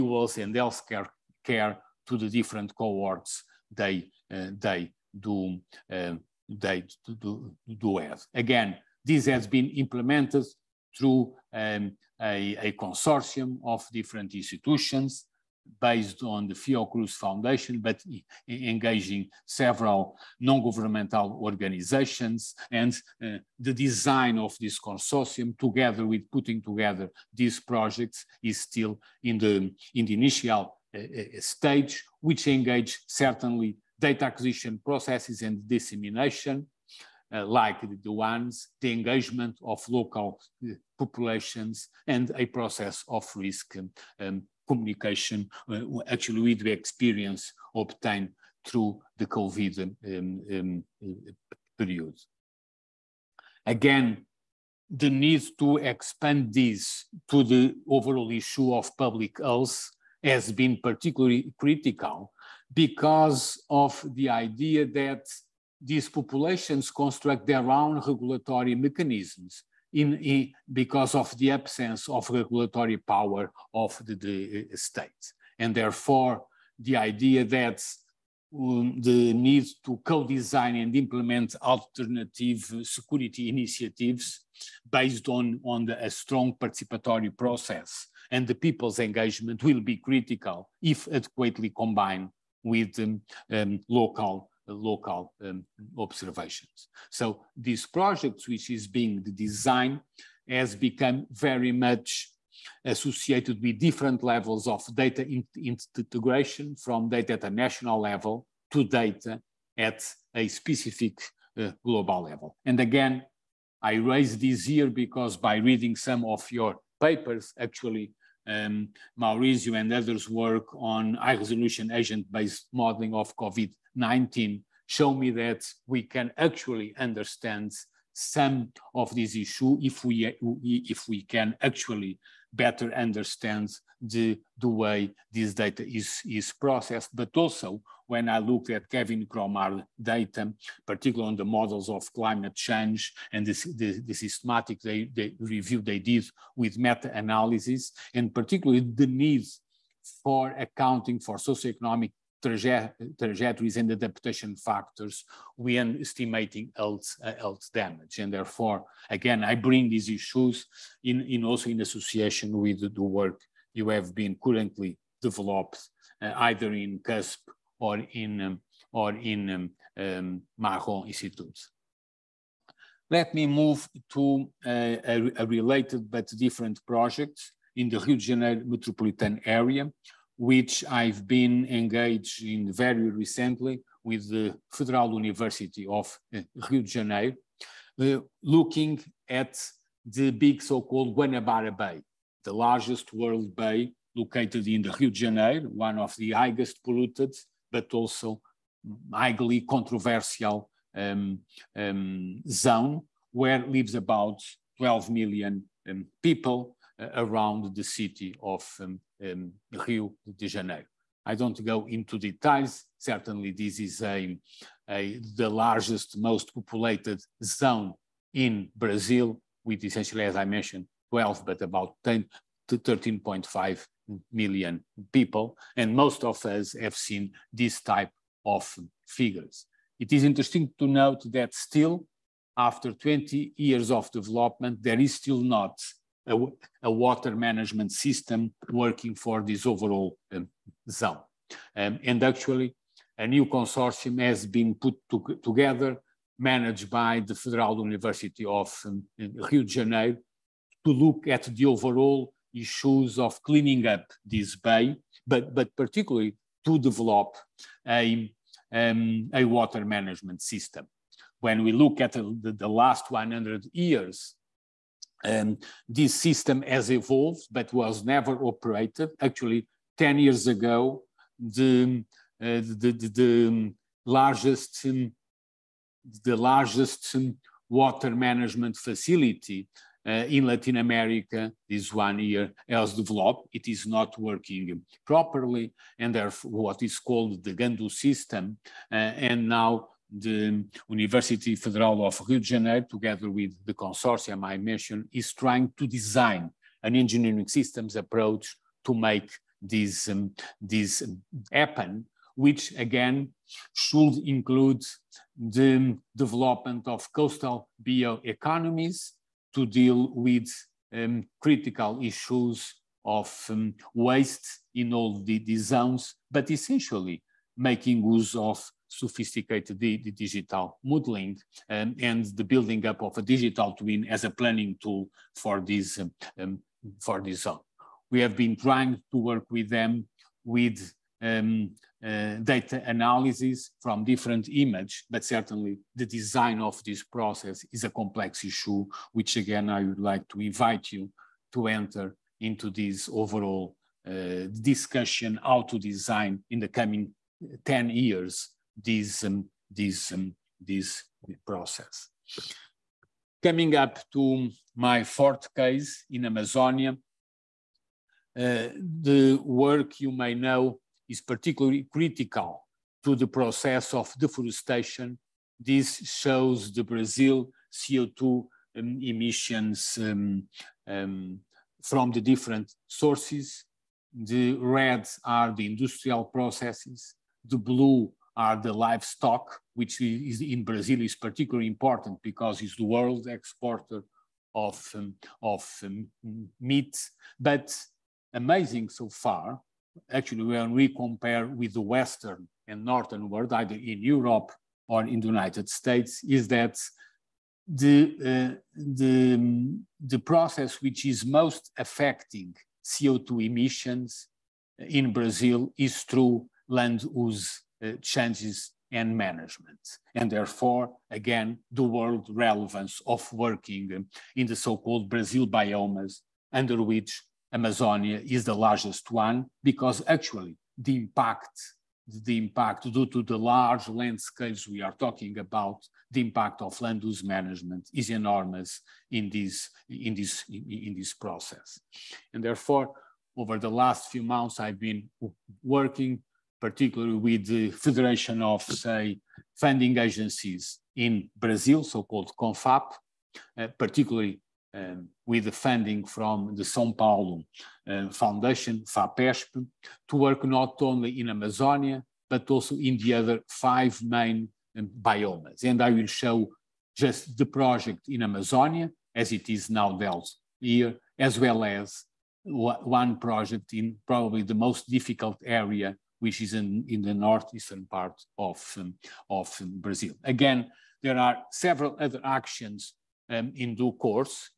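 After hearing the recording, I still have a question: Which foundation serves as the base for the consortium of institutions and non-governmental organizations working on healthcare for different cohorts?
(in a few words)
Fiocruz Foundation.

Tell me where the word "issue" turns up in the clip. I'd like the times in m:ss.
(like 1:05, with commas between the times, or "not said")
0:58, 2:09, 2:40, 4:12, 5:12, 5:38.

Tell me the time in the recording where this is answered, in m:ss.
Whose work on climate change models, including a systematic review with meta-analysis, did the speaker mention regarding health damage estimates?
2:18.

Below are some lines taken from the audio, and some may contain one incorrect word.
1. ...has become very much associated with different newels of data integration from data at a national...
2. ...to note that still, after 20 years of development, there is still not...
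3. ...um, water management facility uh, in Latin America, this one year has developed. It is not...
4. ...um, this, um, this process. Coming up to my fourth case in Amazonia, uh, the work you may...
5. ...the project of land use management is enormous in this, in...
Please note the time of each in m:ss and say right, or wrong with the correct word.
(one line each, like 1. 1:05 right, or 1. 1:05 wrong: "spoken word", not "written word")
1. 1:40 wrong: "levels", not "newels"
2. 3:50 right
3. 4:37 right
4. 5:49 right
5. 7:06 wrong: "impact", not "project".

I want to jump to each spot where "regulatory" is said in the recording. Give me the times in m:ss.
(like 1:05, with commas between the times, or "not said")
1:07, 1:12.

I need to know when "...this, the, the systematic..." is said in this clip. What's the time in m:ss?
2:23.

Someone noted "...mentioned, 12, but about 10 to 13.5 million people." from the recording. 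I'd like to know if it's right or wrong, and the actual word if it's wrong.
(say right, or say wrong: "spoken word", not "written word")
right.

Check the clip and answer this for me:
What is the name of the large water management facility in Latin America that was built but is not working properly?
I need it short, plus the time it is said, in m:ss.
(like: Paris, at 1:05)
Guandu system, at 4:47.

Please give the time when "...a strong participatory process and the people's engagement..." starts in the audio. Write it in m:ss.
1:26.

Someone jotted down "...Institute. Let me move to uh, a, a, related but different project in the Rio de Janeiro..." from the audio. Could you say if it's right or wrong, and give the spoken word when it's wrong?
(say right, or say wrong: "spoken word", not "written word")
right.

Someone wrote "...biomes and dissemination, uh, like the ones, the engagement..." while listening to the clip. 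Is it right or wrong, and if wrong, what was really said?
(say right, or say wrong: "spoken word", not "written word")
wrong: "processes", not "biomes".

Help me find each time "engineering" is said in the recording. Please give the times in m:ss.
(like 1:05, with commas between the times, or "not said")
4:56.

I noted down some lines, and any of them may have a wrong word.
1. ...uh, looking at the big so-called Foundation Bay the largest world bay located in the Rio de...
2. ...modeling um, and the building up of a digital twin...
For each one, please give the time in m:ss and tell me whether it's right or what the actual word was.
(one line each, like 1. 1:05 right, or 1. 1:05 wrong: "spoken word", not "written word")
1. 3:08 wrong: "Guanabara", not "Foundation"
2. 5:20 right.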